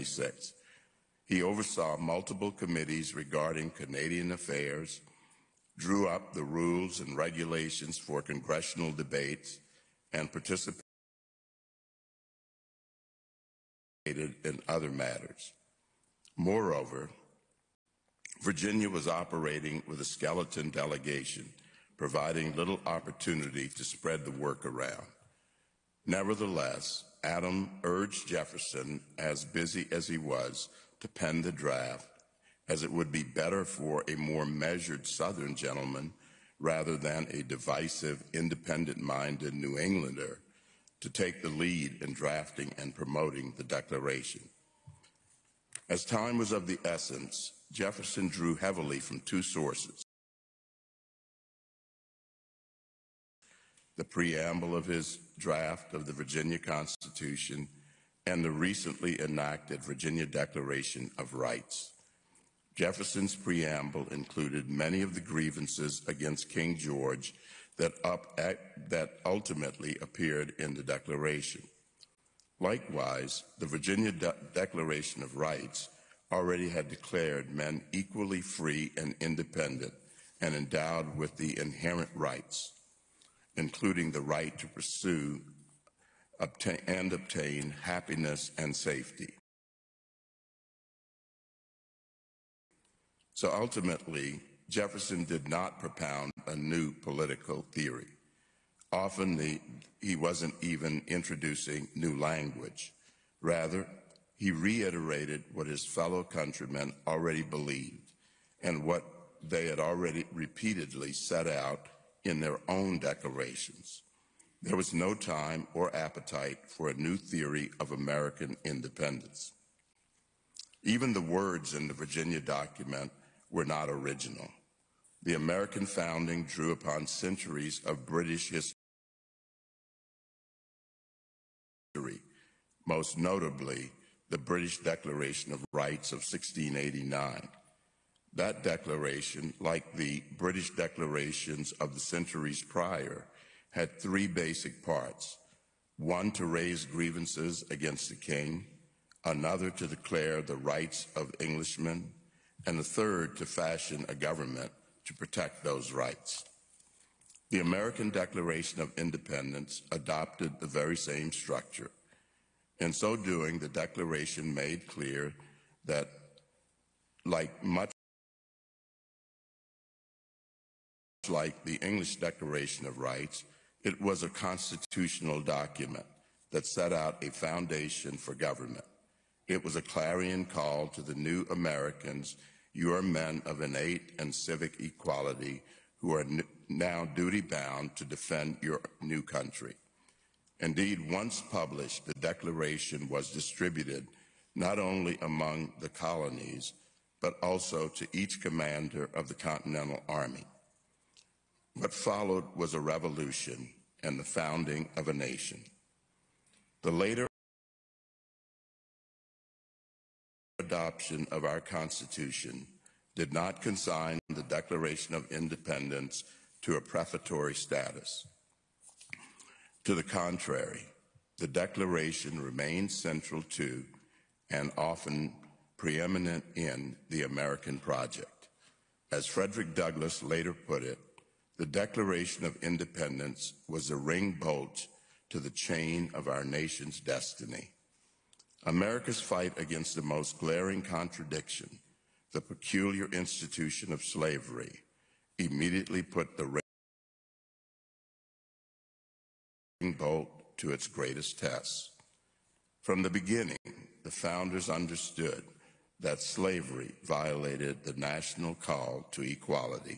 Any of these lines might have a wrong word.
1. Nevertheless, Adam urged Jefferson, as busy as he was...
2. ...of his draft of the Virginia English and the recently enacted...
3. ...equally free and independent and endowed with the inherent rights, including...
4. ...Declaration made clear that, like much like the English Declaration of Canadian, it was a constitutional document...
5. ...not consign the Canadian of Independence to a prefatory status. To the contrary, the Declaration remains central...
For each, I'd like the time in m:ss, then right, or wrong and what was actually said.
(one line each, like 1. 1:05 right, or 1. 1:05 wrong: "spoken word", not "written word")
1. 0:26 right
2. 0:54 wrong: "Constitution", not "English"
3. 1:17 right
4. 2:43 wrong: "Rights", not "Canadian"
5. 3:33 wrong: "Declaration", not "Canadian".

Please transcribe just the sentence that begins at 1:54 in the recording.
There was no time or appetite for a new theory of American independence.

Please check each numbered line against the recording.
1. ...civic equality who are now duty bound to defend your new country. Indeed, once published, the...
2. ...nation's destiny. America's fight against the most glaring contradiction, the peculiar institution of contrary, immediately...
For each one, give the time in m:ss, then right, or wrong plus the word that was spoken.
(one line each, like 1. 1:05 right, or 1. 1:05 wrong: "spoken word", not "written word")
1. 3:04 right
2. 3:56 wrong: "slavery", not "contrary".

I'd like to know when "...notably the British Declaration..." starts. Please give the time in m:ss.
2:13.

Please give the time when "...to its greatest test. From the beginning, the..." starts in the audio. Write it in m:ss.
4:10.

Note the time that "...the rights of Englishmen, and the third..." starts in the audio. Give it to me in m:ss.
2:30.